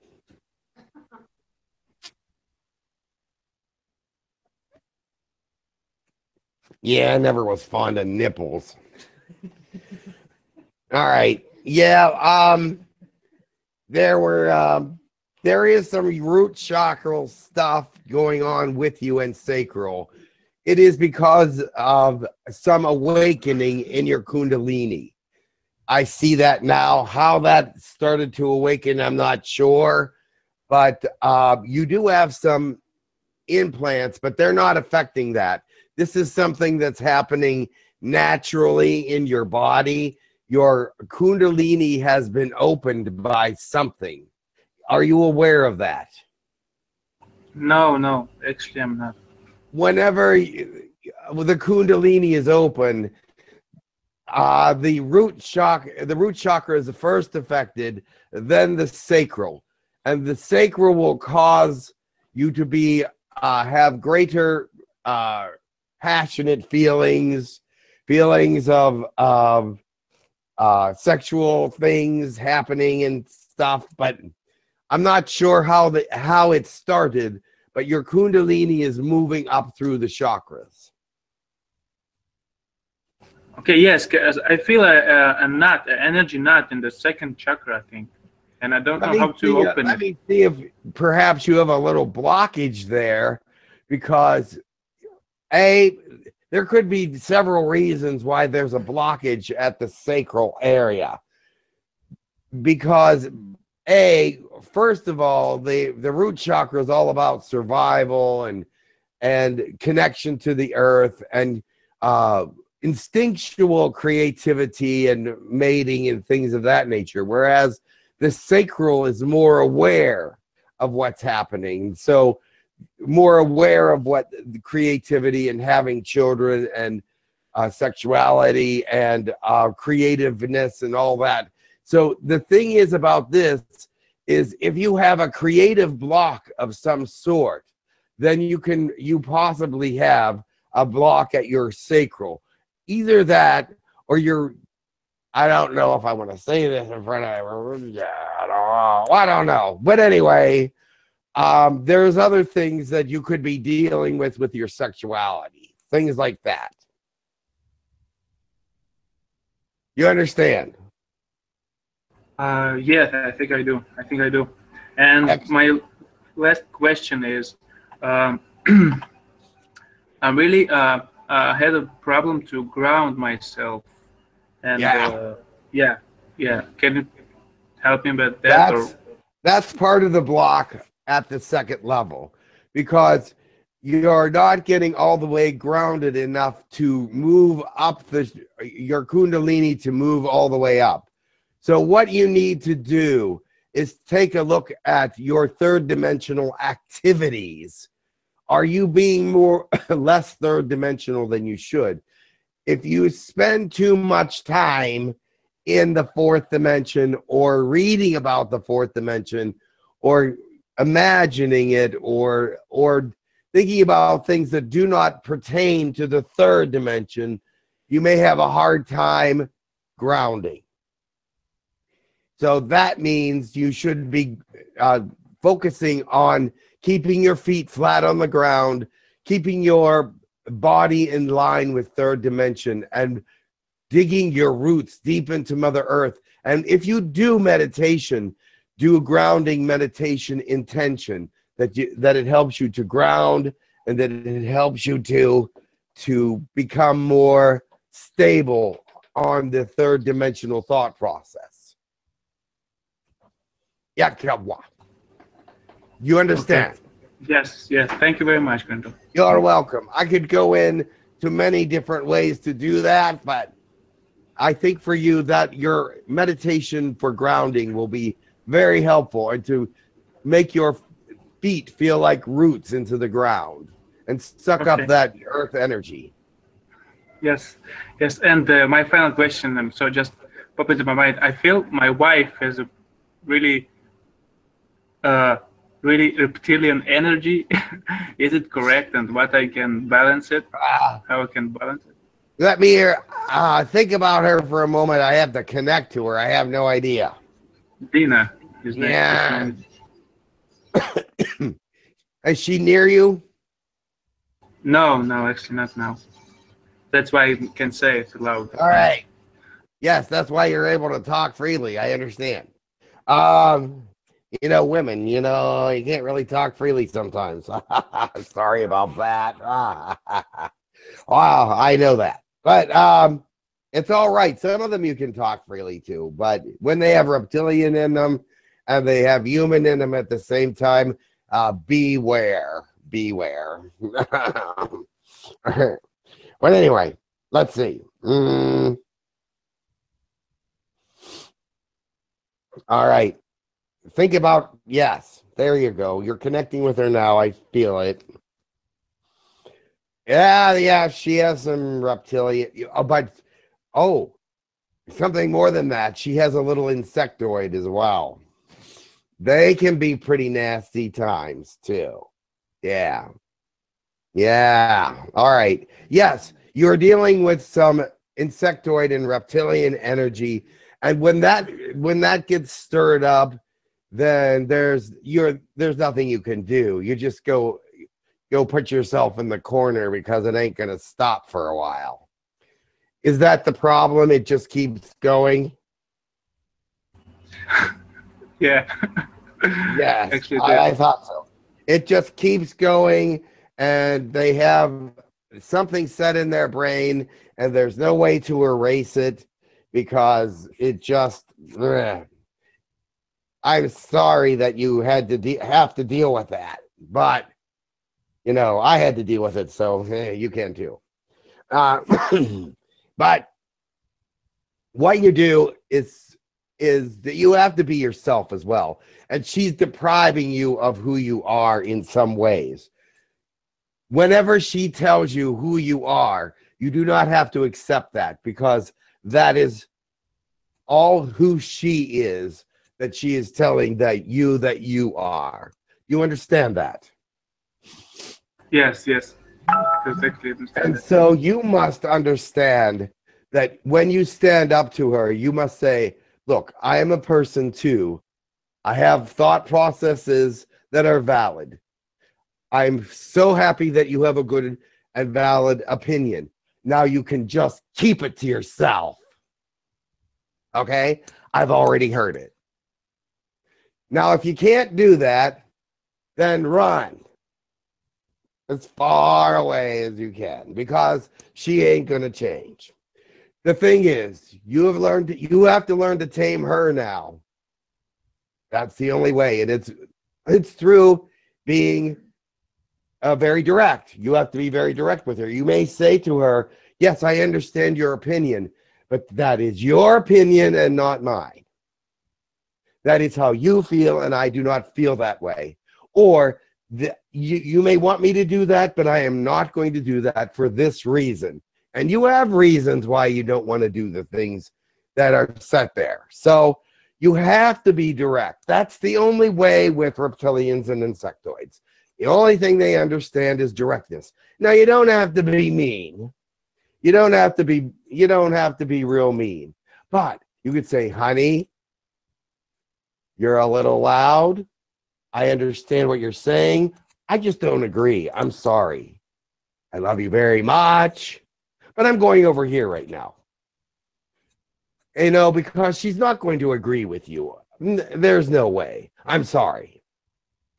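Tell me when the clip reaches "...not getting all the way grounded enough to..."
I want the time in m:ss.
3:04.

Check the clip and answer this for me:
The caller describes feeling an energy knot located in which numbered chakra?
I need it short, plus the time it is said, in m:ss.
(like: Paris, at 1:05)
Second chakra, at 1:26.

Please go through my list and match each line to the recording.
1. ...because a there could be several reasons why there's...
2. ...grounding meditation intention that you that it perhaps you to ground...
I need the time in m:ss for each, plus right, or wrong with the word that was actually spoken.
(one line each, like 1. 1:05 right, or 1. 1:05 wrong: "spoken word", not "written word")
1. 1:33 right
2. 3:58 wrong: "helps", not "perhaps".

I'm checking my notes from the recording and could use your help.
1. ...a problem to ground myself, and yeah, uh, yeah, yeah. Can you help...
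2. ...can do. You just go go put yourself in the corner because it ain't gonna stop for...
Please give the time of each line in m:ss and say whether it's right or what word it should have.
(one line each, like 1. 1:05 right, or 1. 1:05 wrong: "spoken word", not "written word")
1. 2:51 right
2. 6:16 right.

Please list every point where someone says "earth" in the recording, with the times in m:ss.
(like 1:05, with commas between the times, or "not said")
1:50, 3:55, 4:35.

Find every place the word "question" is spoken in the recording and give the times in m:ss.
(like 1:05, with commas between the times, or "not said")
2:46, 4:39.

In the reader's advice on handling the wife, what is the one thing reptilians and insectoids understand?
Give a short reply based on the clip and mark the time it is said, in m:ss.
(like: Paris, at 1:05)
Directness, at 8:33.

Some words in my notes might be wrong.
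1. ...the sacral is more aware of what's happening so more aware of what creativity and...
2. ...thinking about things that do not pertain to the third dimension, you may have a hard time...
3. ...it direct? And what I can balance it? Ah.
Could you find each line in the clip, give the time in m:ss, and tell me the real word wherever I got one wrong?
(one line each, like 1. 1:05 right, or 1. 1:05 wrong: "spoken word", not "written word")
1. 1:58 right
2. 3:33 right
3. 4:48 wrong: "correct", not "direct".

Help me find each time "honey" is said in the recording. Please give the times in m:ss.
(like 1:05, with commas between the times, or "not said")
8:40.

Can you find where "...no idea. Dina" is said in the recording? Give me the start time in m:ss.
4:56.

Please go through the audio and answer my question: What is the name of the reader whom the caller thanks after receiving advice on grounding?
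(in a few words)
Kanto.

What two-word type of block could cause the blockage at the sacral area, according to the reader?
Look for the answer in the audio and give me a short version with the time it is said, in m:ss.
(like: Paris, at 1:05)
Creative block, at 2:15.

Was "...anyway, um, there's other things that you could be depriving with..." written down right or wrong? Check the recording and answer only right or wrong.
wrong.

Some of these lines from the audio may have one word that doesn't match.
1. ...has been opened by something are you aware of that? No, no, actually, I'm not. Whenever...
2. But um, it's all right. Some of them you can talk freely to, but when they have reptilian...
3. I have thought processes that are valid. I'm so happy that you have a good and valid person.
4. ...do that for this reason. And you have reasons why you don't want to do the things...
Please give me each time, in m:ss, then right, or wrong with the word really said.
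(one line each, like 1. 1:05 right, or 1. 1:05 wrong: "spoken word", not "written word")
1. 0:42 right
2. 5:22 right
3. 7:28 wrong: "opinion", not "person"
4. 8:19 right.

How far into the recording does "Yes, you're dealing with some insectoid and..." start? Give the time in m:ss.
6:05.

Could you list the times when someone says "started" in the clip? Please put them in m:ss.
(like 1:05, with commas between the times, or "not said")
0:27, 1:16.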